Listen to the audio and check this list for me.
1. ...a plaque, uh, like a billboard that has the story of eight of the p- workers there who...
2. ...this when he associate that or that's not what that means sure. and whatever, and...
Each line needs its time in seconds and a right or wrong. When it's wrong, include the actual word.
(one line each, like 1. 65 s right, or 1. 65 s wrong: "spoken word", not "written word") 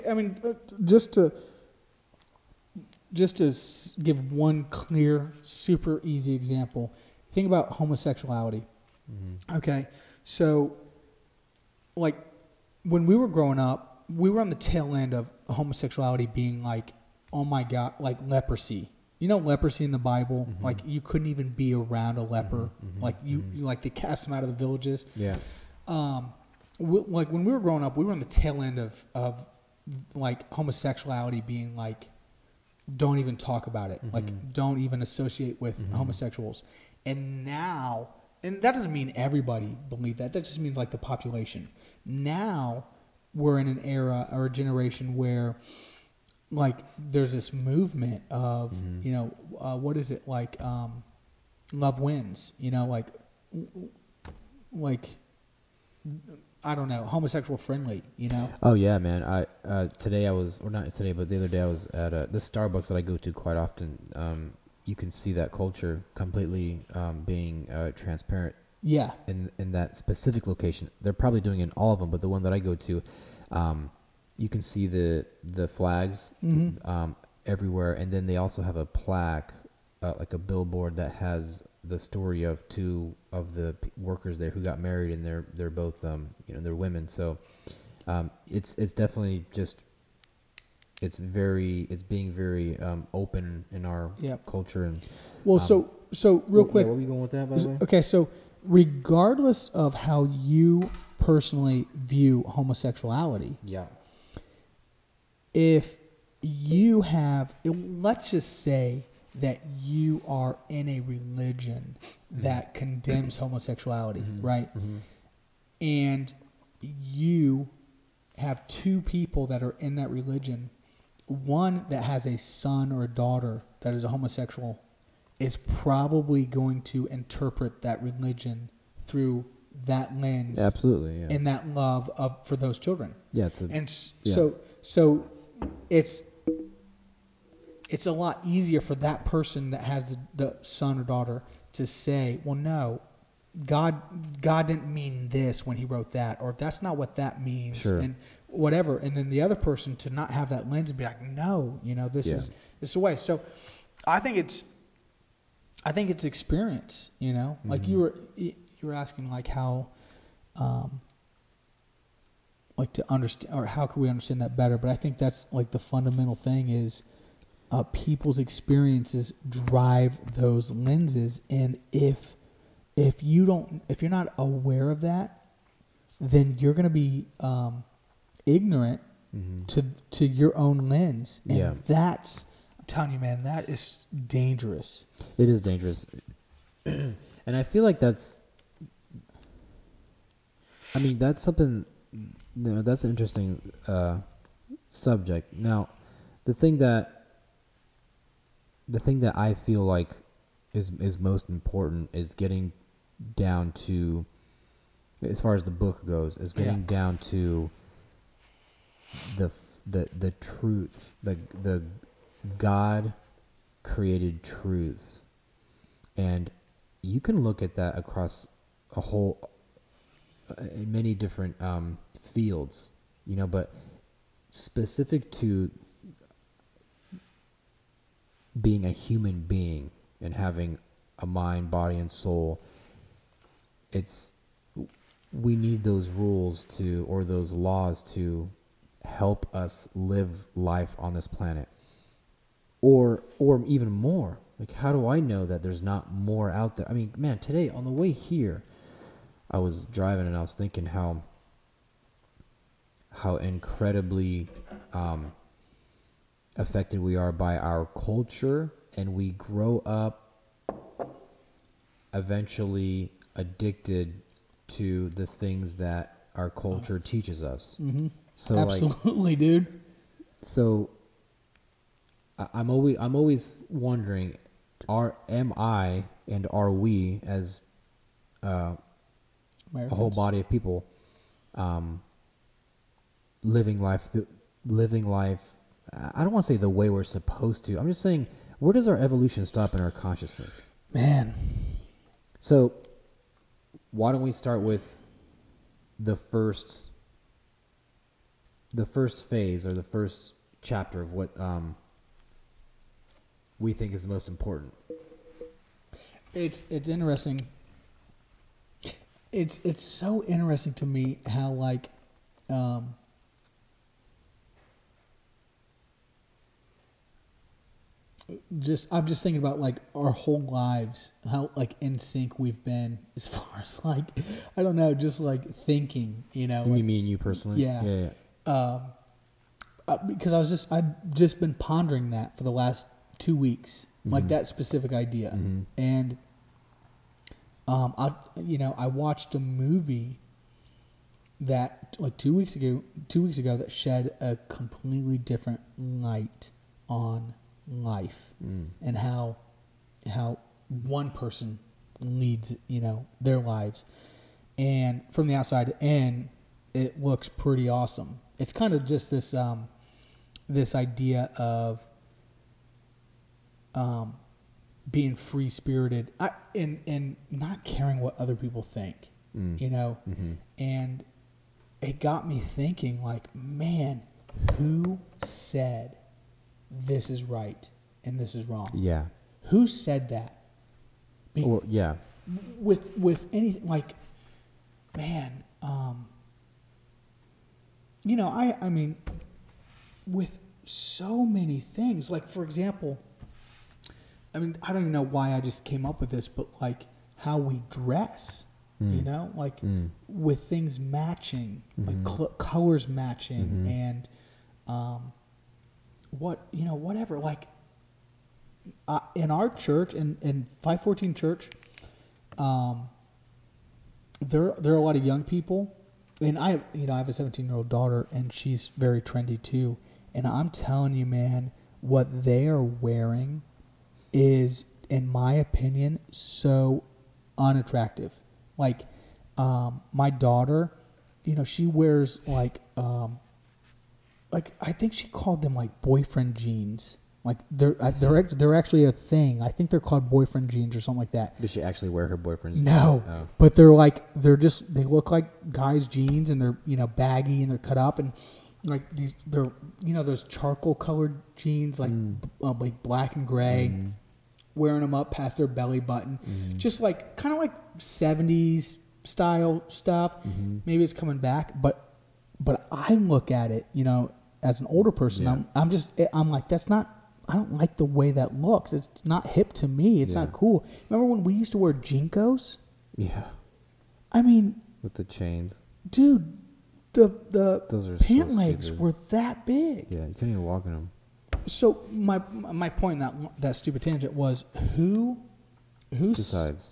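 1. 78 s wrong: "two", not "eight"
2. 145 s wrong: "wrote", not "associate".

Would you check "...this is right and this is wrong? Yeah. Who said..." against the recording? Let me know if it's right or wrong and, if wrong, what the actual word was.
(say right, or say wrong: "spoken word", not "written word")
right.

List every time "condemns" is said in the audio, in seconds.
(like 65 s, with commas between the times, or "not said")
112 s.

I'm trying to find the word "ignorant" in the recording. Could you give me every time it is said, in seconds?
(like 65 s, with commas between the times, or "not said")
178 s.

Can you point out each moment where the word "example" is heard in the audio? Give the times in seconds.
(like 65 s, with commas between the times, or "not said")
6 s, 392 s.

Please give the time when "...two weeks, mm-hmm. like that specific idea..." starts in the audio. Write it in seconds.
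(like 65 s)
333 s.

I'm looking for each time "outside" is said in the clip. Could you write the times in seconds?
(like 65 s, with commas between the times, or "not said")
355 s.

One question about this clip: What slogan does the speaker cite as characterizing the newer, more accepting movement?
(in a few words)
Love wins.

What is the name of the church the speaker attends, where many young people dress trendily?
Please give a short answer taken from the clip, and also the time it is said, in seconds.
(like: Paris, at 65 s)
Five Fourteen Church, at 410 s.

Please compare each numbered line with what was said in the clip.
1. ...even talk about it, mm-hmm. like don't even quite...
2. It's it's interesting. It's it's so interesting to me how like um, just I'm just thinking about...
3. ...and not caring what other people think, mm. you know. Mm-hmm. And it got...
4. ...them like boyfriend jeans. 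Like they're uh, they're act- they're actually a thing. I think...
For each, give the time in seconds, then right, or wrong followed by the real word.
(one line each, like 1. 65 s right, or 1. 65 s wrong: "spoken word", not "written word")
1. 33 s wrong: "associate", not "quite"
2. 306 s right
3. 366 s right
4. 435 s right.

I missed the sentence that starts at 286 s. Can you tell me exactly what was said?
I don't want to say the way we're supposed to.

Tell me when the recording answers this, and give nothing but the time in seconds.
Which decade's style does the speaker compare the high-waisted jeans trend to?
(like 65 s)
457 s.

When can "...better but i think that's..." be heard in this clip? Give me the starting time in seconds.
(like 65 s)
164 s.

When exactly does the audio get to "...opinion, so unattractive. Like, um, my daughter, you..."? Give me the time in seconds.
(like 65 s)
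425 s.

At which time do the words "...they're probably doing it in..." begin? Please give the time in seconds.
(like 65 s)
71 s.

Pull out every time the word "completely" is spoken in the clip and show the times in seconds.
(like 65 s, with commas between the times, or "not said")
66 s, 344 s.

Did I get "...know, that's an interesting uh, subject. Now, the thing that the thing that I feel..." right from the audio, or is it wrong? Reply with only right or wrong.
right.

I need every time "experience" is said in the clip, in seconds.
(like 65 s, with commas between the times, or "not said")
156 s, 168 s.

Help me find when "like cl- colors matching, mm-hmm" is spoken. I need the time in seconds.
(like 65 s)
402 s.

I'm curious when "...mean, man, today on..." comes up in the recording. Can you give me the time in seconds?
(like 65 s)
246 s.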